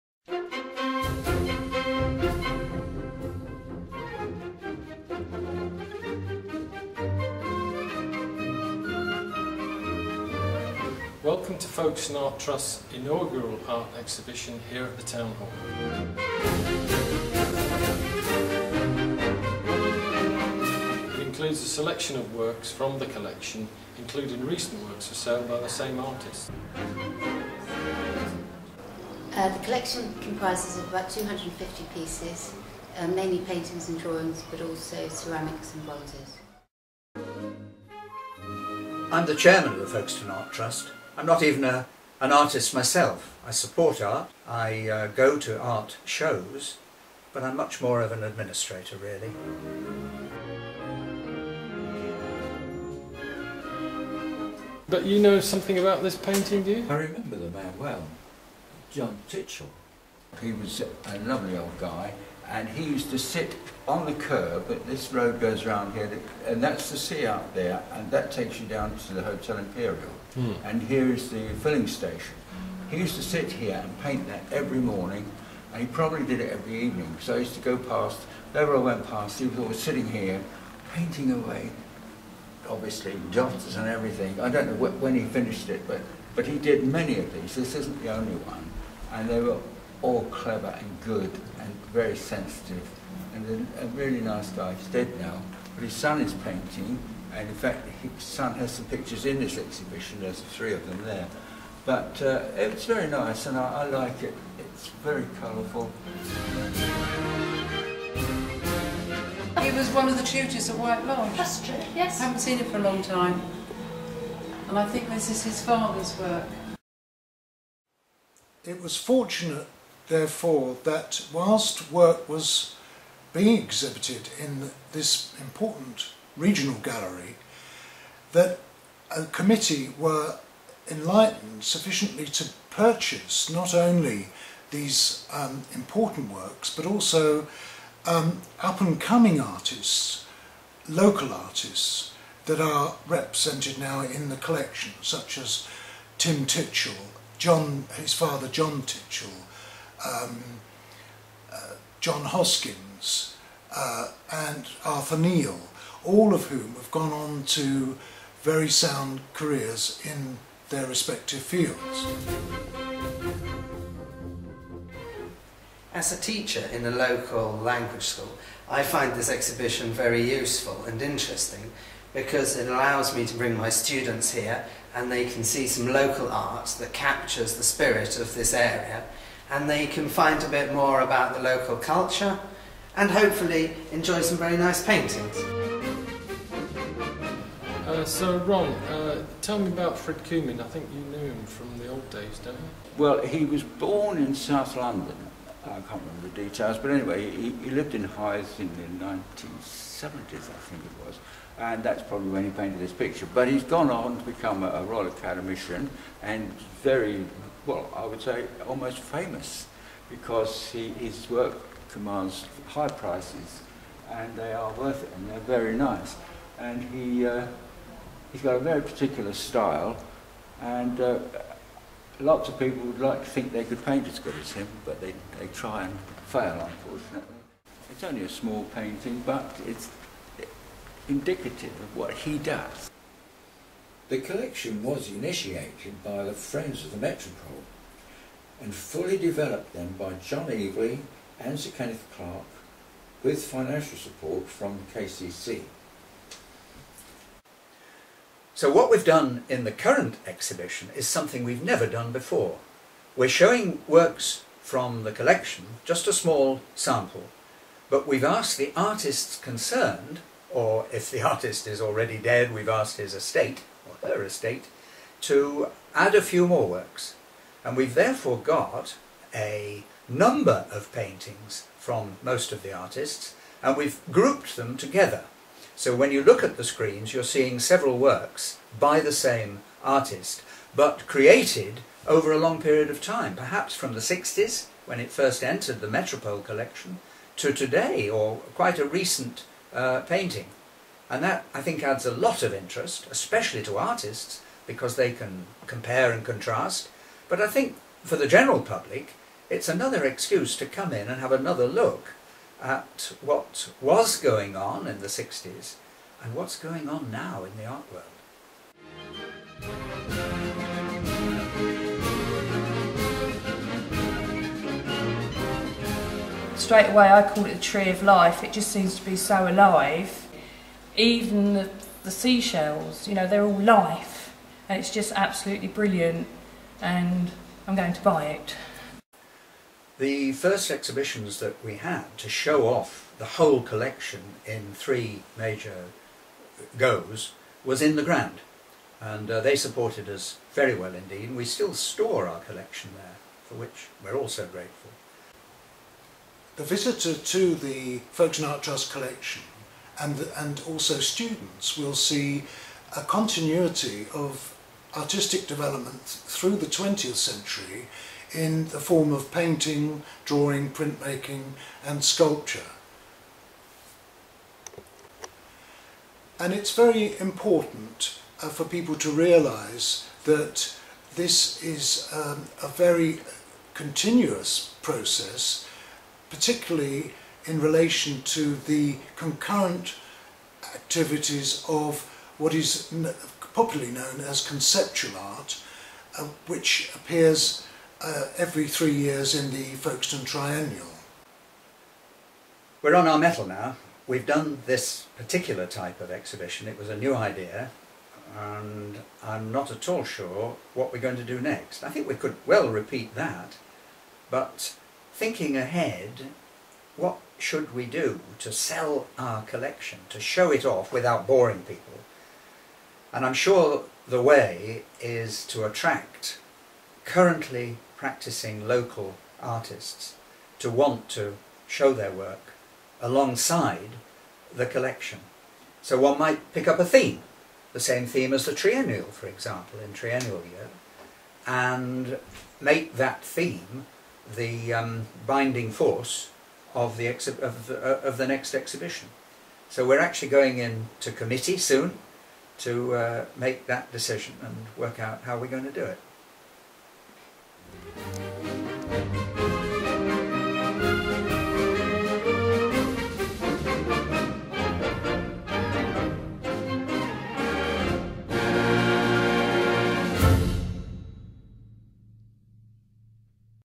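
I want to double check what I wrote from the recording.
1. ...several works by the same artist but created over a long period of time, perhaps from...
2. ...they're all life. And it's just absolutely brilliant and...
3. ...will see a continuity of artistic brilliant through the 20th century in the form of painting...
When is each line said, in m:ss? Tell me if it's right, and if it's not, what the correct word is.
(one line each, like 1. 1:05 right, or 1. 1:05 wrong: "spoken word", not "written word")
1. 4:37 right
2. 5:23 right
3. 5:51 wrong: "development", not "brilliant".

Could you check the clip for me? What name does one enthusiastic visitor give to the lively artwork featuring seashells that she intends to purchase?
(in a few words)
The tree of life.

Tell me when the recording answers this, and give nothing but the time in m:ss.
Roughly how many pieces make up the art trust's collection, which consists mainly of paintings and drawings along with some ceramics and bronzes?
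0:31.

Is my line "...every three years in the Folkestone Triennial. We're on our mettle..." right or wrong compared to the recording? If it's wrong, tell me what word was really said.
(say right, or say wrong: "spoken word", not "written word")
right.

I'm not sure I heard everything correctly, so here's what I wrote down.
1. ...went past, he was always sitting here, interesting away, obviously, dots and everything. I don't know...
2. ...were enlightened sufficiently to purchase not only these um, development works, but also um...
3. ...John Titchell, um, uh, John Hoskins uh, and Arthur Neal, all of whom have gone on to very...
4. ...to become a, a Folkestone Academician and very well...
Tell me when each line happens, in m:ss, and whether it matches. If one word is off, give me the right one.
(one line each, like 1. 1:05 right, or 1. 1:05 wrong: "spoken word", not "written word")
1. 1:18 wrong: "painting", not "interesting"
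2. 2:09 wrong: "important", not "development"
3. 2:28 right
4. 3:24 wrong: "Royal", not "Folkestone".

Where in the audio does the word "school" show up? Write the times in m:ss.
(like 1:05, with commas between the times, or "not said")
2:48.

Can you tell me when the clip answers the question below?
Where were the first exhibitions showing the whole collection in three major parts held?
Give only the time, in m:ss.
5:37.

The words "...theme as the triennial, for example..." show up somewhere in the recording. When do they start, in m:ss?
7:08.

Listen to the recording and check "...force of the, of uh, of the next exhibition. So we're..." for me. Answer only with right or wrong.
right.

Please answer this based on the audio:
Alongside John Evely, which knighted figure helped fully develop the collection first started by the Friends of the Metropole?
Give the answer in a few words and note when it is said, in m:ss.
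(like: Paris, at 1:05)
Sir Kenneth Clark, at 4:01.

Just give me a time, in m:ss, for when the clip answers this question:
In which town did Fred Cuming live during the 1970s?
3:18.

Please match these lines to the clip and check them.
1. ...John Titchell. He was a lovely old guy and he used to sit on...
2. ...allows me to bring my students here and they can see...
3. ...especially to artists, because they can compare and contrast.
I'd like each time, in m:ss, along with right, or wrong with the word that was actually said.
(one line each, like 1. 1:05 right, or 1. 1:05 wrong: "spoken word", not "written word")
1. 0:58 right
2. 2:52 right
3. 4:53 right.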